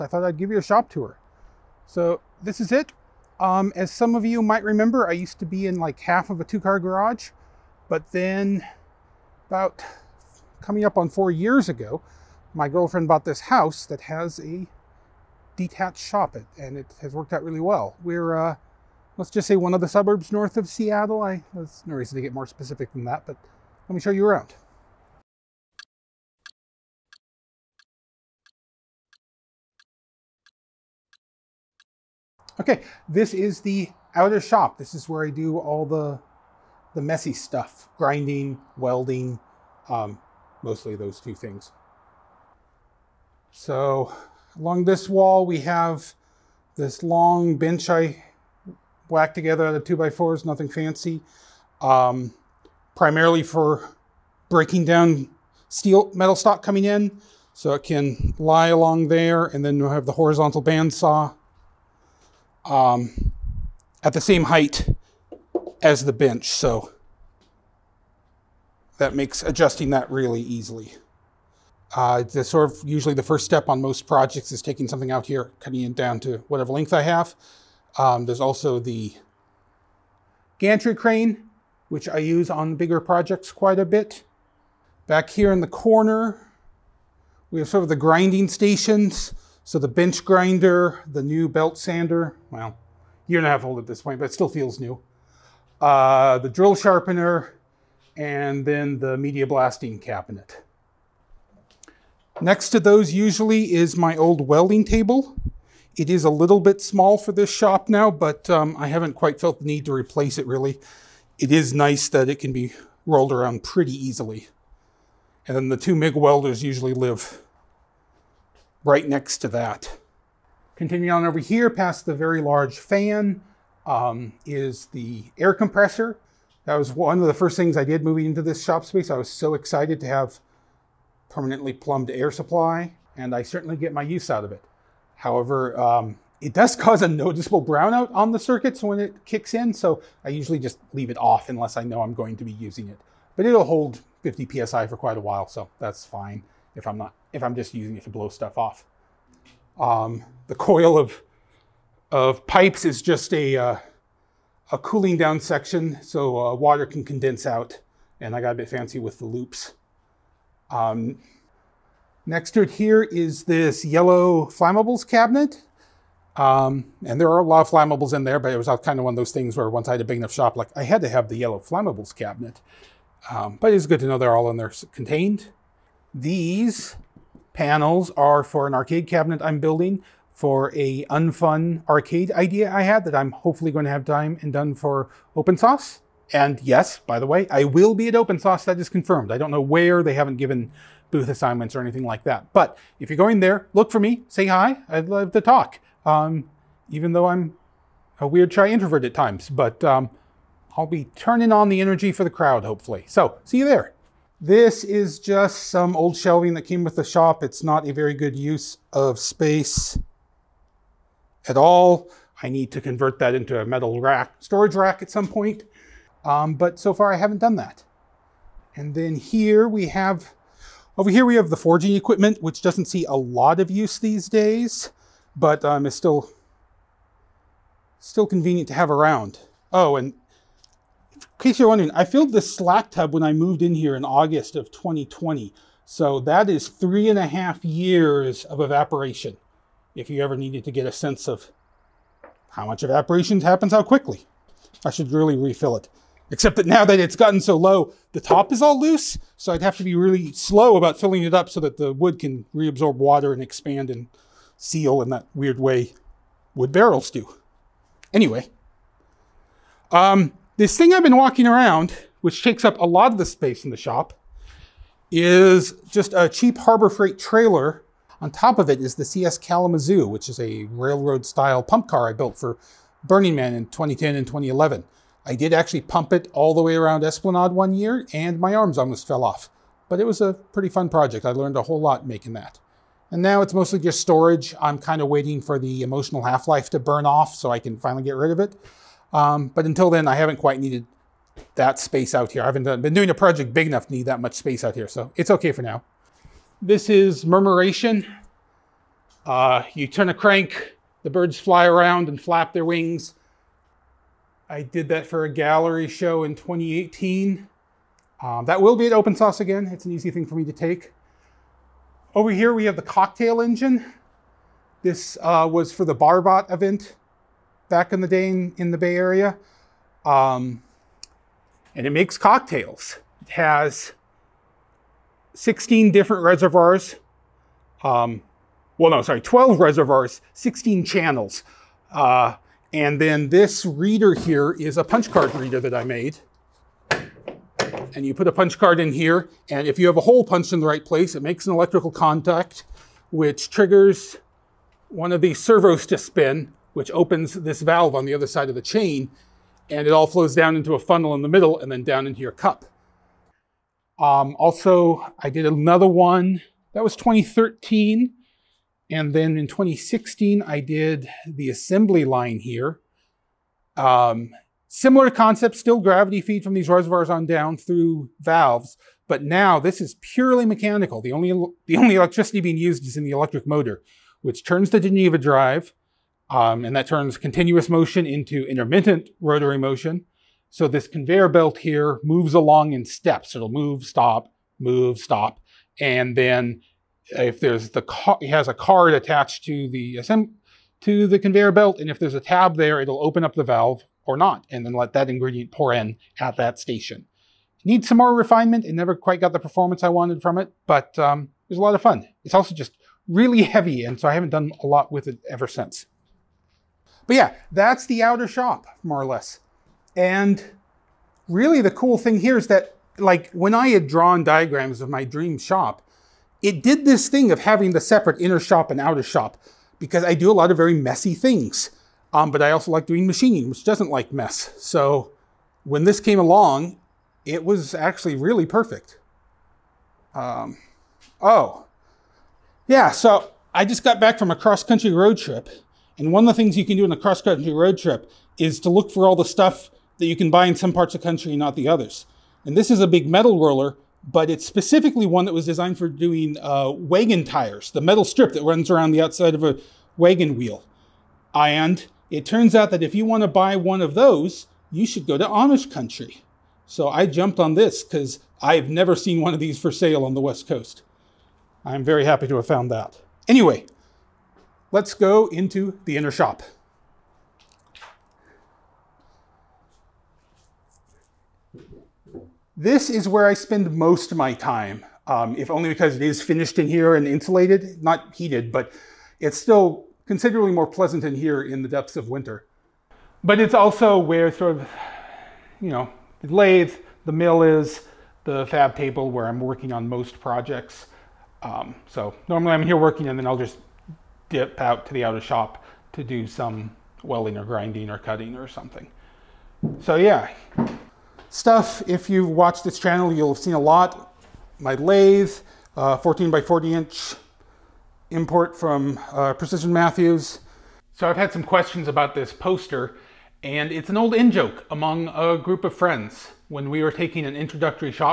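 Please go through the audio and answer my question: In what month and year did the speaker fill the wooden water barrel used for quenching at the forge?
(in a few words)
August 2020.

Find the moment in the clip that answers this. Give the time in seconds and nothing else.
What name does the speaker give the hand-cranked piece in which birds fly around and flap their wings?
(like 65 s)
297 s.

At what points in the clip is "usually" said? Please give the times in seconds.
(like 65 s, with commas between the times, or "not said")
72 s, 103 s, 116 s, 140 s.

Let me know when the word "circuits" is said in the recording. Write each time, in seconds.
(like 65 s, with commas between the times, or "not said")
138 s.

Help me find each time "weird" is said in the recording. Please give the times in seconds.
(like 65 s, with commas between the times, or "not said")
198 s, 255 s.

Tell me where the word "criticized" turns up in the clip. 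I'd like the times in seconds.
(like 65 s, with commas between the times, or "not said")
not said.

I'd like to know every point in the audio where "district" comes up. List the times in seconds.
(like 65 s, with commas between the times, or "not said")
not said.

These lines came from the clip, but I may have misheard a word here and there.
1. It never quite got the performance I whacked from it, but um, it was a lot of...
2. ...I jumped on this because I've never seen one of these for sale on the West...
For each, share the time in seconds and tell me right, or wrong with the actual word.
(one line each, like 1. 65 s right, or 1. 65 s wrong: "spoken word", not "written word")
1. 398 s wrong: "wanted", not "whacked"
2. 456 s right.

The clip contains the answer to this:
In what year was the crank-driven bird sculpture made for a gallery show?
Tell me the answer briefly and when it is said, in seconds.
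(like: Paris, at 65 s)
2018, at 306 s.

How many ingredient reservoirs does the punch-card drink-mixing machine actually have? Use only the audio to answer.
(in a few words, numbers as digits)
12.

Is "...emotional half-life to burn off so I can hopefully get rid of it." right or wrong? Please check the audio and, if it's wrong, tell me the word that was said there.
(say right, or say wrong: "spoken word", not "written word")
wrong: "finally", not "hopefully".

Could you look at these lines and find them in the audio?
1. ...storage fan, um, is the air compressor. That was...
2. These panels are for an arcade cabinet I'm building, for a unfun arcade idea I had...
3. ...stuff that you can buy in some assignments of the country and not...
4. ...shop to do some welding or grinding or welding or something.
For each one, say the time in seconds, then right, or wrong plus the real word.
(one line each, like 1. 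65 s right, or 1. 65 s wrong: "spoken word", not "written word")
1. 122 s wrong: "large", not "storage"
2. 176 s right
3. 439 s wrong: "parts", not "assignments"
4. 495 s wrong: "cutting", not "welding".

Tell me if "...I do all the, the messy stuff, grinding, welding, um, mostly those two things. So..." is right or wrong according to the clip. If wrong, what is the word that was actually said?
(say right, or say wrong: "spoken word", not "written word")
right.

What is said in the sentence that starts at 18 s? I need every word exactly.
We're, uh, let's just say one of the suburbs north of Seattle.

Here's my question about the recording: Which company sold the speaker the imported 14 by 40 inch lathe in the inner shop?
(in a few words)
Precision Matthews.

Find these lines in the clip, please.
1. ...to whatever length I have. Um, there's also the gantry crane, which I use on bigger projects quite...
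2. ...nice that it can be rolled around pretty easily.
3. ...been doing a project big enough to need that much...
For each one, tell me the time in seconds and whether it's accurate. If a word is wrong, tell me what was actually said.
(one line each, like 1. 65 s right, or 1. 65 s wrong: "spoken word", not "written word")
1. 76 s right
2. 111 s right
3. 292 s right.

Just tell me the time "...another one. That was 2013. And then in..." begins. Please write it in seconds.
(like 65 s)
355 s.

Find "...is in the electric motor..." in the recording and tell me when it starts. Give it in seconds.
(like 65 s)
372 s.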